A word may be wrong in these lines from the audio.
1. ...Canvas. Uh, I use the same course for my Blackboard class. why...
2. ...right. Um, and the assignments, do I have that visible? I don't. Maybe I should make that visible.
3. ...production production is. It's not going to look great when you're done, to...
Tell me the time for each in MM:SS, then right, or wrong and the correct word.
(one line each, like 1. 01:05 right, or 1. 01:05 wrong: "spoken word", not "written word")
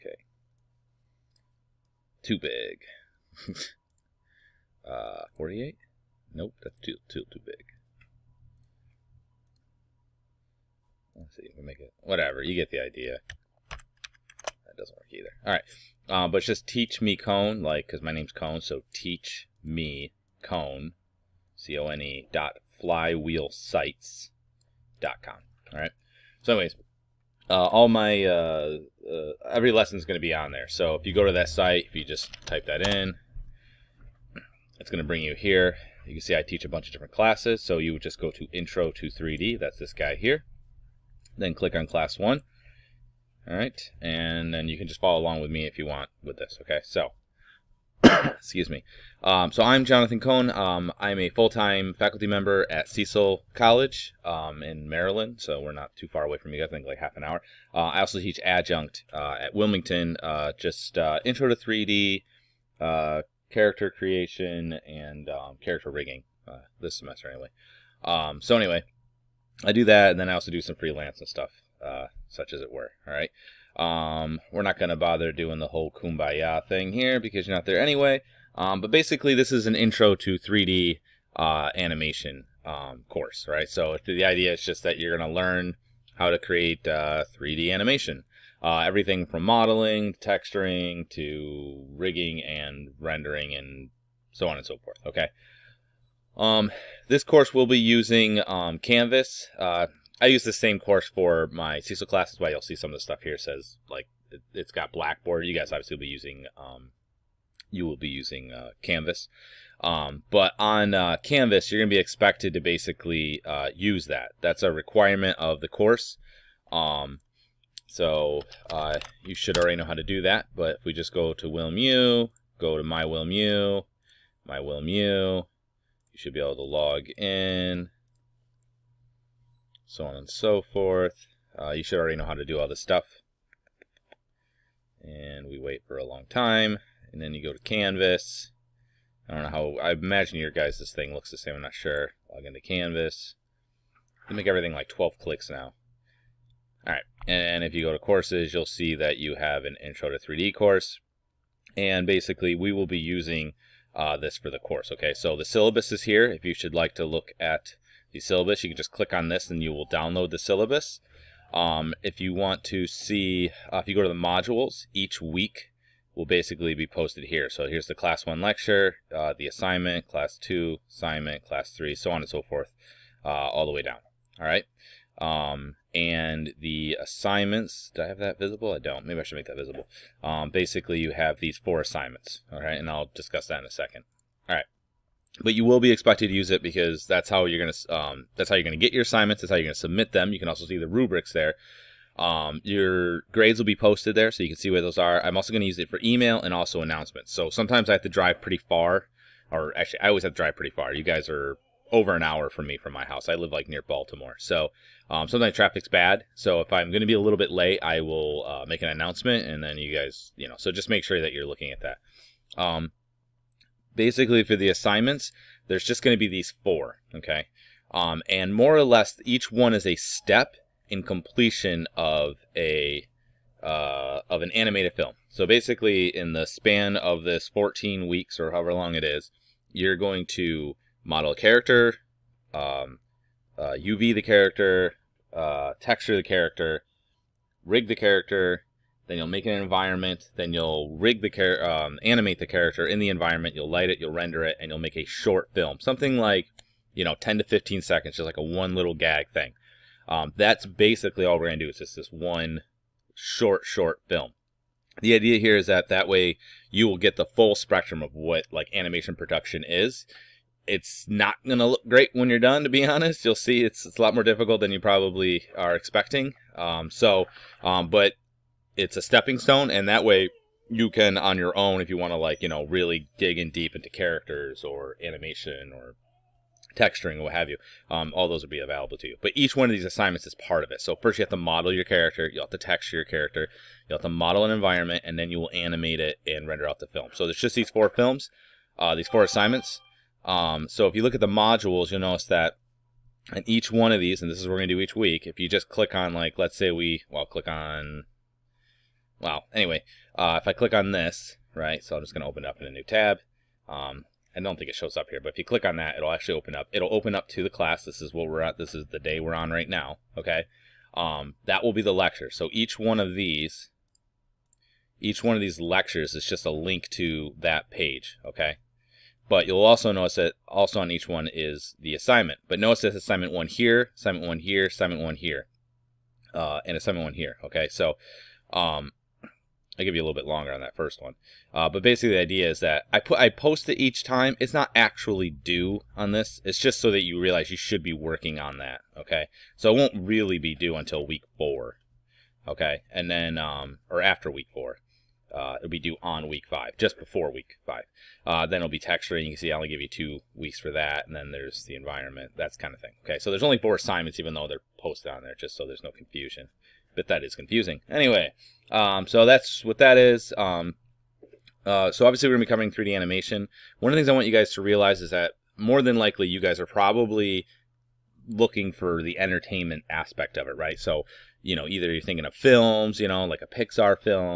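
1. 01:38 wrong: "Cecil", not "Blackboard"
2. 02:54 right
3. 04:18 wrong: "animation", not "production".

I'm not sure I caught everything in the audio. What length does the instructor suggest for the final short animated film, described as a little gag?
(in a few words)
10 to 15 seconds.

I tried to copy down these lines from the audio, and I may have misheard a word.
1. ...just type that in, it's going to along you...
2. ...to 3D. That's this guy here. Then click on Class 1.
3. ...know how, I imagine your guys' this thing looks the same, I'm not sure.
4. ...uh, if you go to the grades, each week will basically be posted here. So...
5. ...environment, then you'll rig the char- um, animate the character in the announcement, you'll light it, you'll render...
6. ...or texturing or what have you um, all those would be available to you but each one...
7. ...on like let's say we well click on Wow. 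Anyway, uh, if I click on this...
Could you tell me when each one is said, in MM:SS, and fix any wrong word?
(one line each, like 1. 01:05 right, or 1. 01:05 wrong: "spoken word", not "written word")
1. 00:32 wrong: "bring", not "along"
2. 00:38 right
3. 02:19 right
4. 02:43 wrong: "modules", not "grades"
5. 03:59 wrong: "environment", not "announcement"
6. 04:35 right
7. 04:55 right.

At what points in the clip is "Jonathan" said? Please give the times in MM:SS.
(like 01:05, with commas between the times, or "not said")
00:49.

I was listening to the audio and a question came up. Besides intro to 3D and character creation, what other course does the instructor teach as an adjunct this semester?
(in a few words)
Character rigging.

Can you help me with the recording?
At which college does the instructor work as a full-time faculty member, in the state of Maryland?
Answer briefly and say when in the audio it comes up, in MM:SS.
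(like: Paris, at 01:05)
Cecil College, at 00:52.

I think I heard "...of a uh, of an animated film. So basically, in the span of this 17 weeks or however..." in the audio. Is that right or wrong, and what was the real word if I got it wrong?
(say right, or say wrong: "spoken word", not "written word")
wrong: "14", not "17".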